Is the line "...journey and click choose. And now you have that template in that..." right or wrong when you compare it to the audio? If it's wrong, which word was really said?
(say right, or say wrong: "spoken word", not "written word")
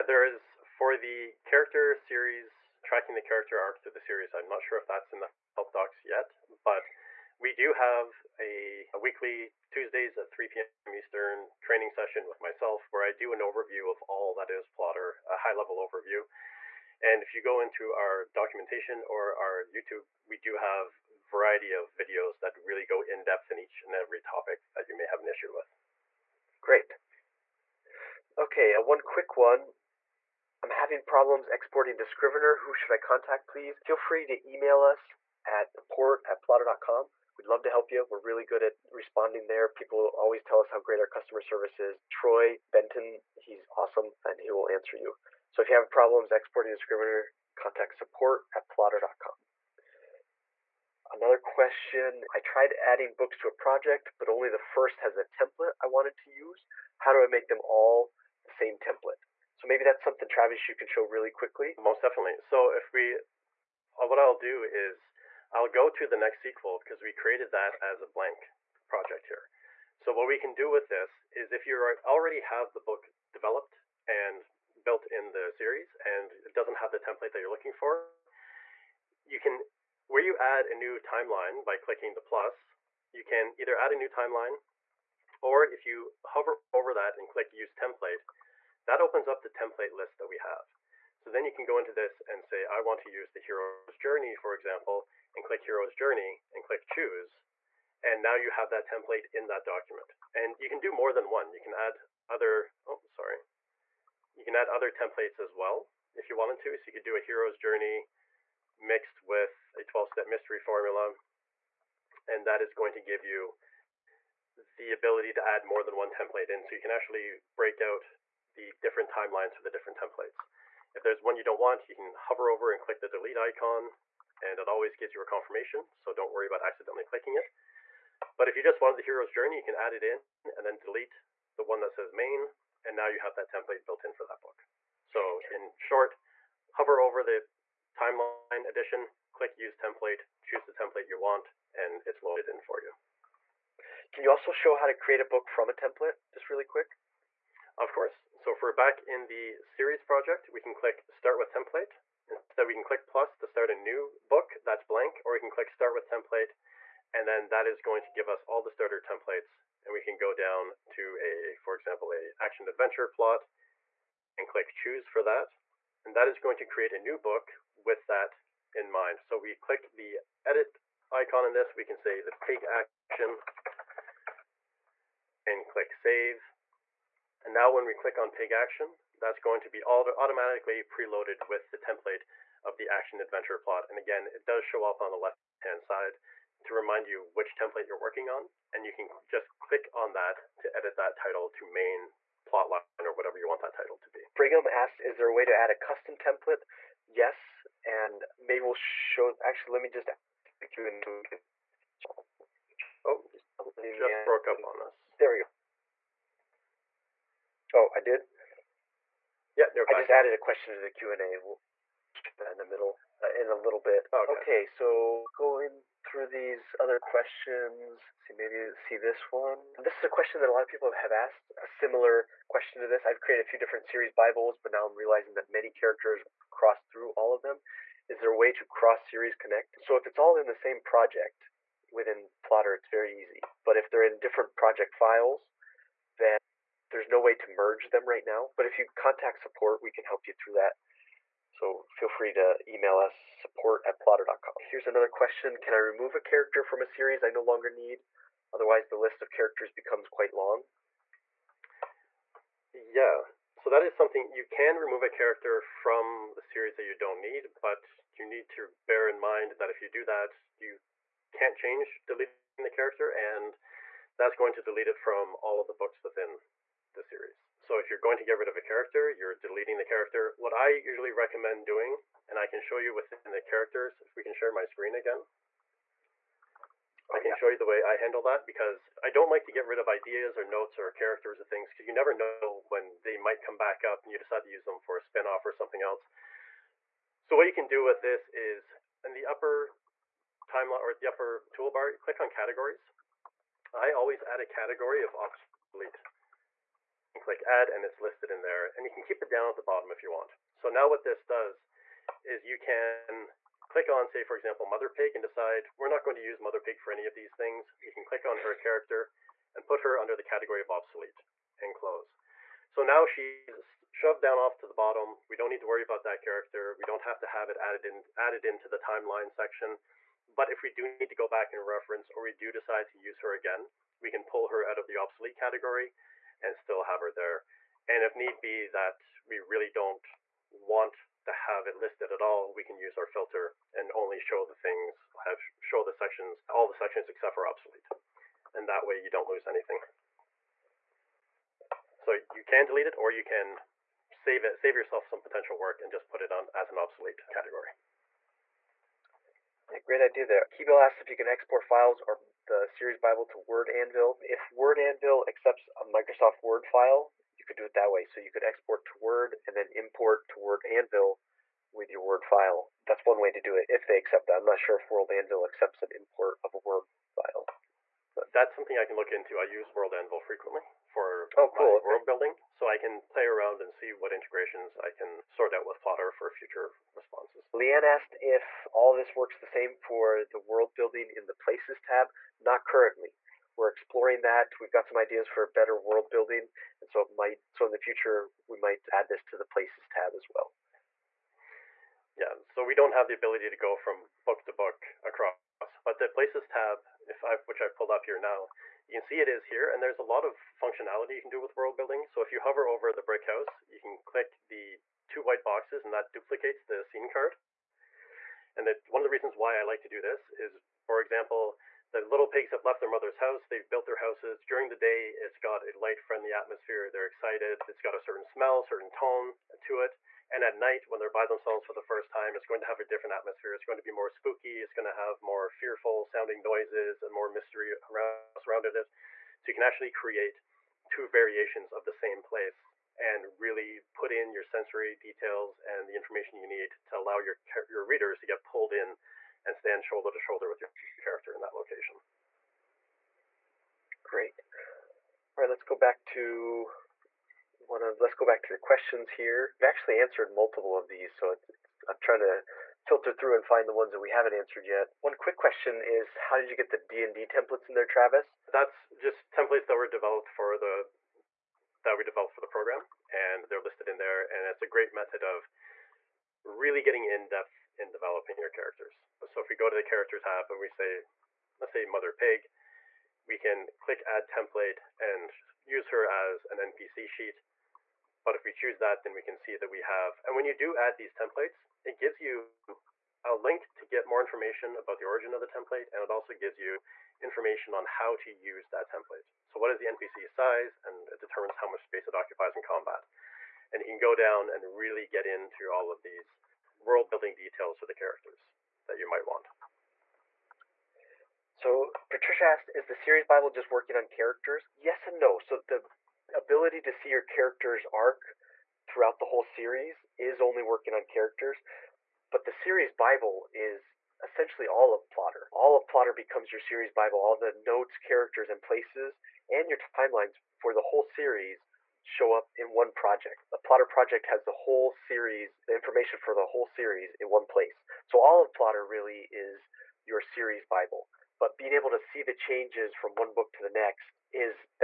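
right.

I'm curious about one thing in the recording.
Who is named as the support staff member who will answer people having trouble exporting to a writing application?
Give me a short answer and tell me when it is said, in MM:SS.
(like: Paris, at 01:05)
Troy Benton, at 00:42.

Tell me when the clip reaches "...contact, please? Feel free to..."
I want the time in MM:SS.
00:32.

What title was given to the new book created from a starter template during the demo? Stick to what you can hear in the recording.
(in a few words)
The Pig Action.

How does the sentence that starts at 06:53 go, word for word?
They've built their houses during the day.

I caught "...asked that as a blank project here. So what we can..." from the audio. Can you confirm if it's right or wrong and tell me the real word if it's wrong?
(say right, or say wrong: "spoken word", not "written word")
wrong: "created", not "asked".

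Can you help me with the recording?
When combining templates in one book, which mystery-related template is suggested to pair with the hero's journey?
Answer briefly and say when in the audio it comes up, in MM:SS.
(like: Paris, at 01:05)
12 step mystery formula, at 01:49.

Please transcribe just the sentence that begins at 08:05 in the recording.
And it also gives you information on how to use that template.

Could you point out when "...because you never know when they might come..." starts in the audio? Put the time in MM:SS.
04:41.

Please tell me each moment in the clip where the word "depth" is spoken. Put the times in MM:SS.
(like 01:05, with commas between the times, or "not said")
00:23, 07:47.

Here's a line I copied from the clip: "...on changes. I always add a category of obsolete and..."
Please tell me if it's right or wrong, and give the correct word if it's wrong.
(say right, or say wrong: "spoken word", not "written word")
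wrong: "categories", not "changes".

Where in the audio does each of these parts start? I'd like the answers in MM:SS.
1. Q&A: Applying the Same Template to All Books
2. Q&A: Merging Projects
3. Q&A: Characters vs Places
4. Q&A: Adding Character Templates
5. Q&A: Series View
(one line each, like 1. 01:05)
1. 00:56
2. 03:56
3. 06:21
4. 07:36
5. 08:24.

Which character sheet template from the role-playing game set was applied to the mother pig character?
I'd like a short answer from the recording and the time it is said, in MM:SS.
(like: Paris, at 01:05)
NPC sheet, at 07:56.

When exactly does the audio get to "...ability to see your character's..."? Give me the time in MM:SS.
08:26.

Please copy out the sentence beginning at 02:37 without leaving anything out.
And then that is going to give us all the starter templates.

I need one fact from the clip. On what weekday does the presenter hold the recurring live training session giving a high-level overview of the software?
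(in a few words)
Tuesdays.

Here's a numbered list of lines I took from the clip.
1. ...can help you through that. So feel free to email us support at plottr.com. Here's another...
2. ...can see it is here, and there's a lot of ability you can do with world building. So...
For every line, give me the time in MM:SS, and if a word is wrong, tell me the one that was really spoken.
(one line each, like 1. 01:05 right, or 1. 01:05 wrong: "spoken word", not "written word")
1. 03:59 right
2. 06:38 wrong: "functionality", not "ability".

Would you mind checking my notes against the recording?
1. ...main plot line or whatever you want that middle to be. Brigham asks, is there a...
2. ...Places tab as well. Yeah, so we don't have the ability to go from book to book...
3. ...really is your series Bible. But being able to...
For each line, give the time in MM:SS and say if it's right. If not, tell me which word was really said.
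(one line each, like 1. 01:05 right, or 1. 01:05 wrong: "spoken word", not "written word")
1. 03:11 wrong: "title", not "middle"
2. 06:29 right
3. 08:48 right.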